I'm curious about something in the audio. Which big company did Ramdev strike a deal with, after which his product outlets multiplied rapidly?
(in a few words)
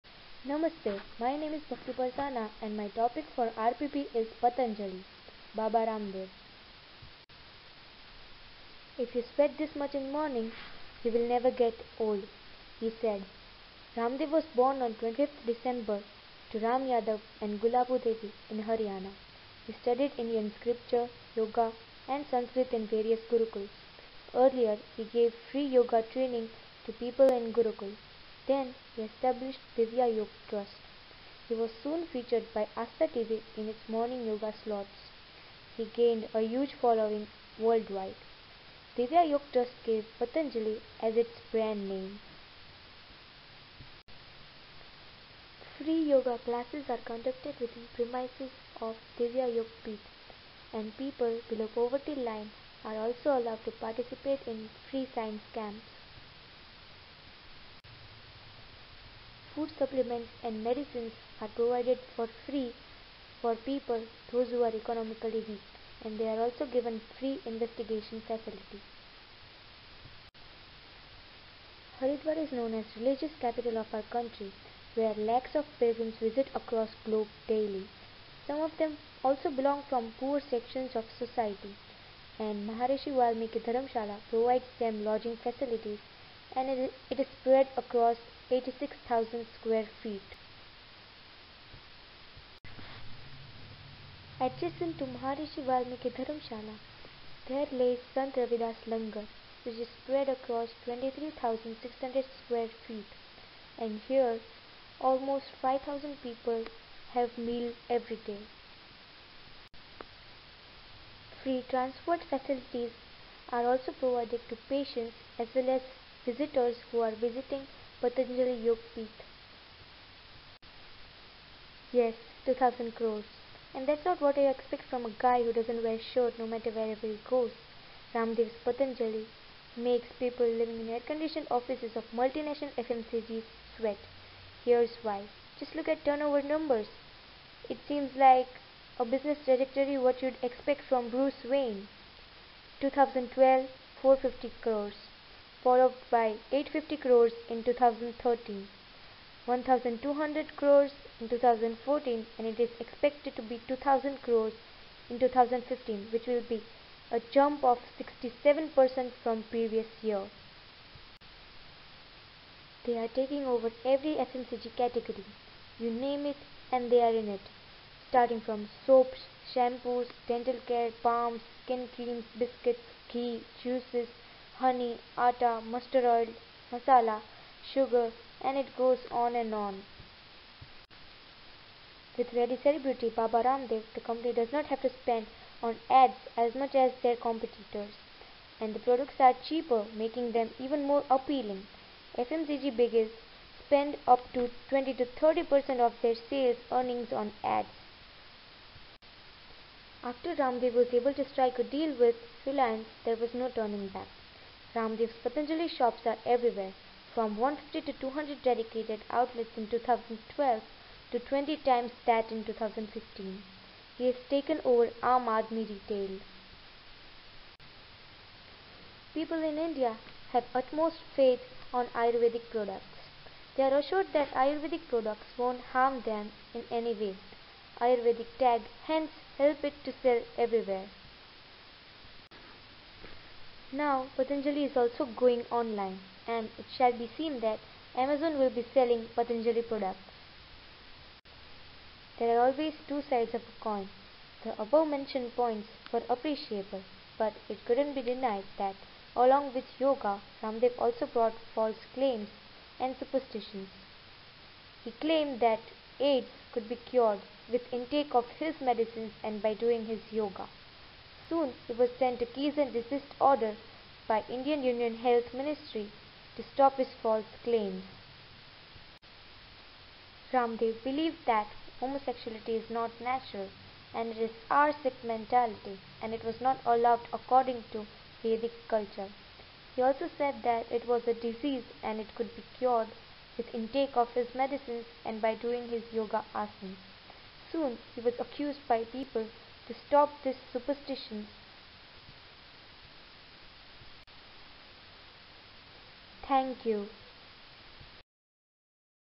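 Reliance.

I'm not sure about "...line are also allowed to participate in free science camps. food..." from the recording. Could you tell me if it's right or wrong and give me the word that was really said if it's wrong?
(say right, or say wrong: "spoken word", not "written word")
right.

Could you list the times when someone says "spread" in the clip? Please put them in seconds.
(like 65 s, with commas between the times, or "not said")
87 s, 100 s.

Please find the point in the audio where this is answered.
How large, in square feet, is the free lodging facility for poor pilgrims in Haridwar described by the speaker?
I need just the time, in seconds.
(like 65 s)
88 s.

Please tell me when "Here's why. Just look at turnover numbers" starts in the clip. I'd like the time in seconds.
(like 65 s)
134 s.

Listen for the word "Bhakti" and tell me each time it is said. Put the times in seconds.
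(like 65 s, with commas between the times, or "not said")
1 s.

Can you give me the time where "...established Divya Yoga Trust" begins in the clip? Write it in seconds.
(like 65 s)
29 s.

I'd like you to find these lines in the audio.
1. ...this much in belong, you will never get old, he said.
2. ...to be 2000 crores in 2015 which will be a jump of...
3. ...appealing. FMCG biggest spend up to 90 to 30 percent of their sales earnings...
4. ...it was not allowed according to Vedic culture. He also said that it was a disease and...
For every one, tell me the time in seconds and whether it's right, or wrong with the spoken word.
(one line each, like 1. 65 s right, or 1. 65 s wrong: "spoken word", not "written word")
1. 9 s wrong: "morning", not "belong"
2. 153 s right
3. 191 s wrong: "20", not "90"
4. 276 s right.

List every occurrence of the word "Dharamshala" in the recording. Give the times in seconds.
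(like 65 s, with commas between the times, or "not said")
83 s, 96 s.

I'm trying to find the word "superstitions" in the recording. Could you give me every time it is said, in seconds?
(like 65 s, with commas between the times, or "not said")
252 s, 290 s.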